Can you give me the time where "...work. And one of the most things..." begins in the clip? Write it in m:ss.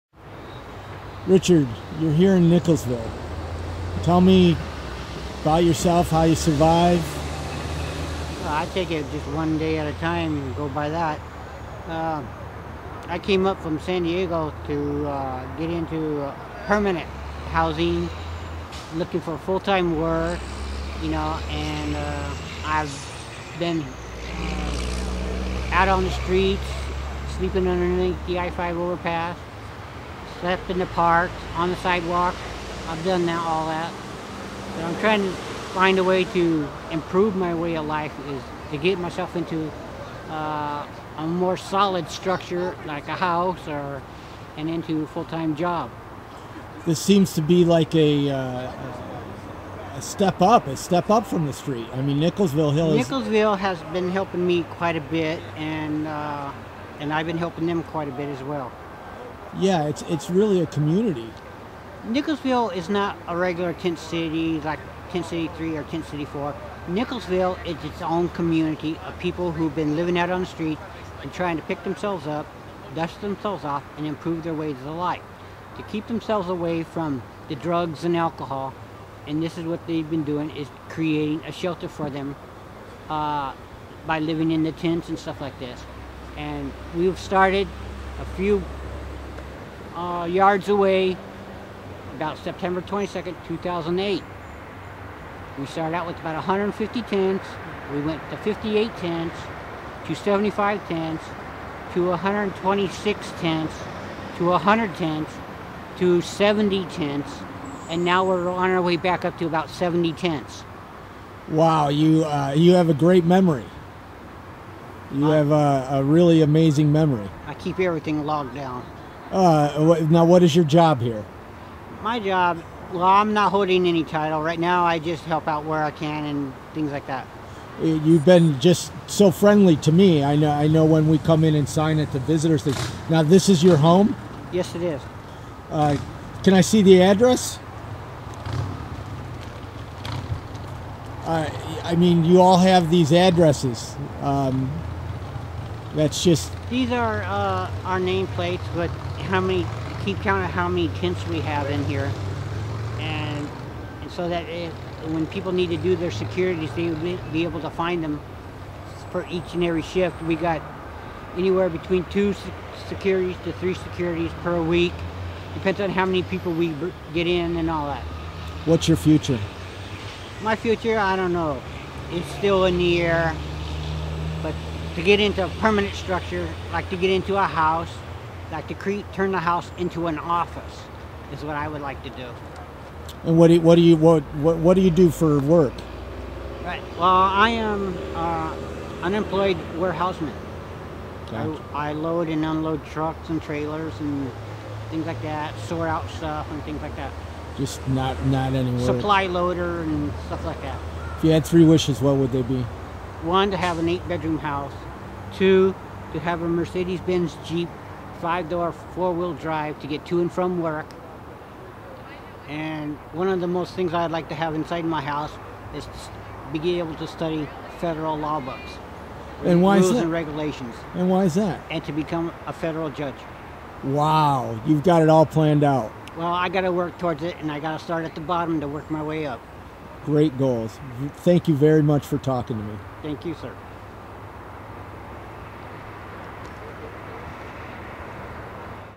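3:30.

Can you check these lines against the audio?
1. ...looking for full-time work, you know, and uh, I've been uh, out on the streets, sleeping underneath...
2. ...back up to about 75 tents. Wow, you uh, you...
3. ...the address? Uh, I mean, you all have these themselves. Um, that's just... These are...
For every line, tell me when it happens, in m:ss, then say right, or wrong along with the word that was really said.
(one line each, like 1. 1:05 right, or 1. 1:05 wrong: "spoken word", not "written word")
1. 0:18 right
2. 1:48 wrong: "70", not "75"
3. 2:16 wrong: "addresses", not "themselves".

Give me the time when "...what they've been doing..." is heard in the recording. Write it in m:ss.
1:19.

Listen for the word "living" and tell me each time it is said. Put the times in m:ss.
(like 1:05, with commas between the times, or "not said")
1:09, 1:24.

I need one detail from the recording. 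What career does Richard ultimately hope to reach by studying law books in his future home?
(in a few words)
federal judge.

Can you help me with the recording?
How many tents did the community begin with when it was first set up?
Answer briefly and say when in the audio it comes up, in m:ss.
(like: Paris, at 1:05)
150, at 1:36.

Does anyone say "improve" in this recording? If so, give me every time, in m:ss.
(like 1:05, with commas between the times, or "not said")
0:36, 1:14.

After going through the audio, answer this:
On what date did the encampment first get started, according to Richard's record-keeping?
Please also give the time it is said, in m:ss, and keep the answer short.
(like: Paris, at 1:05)
September 22, 2008, at 1:32.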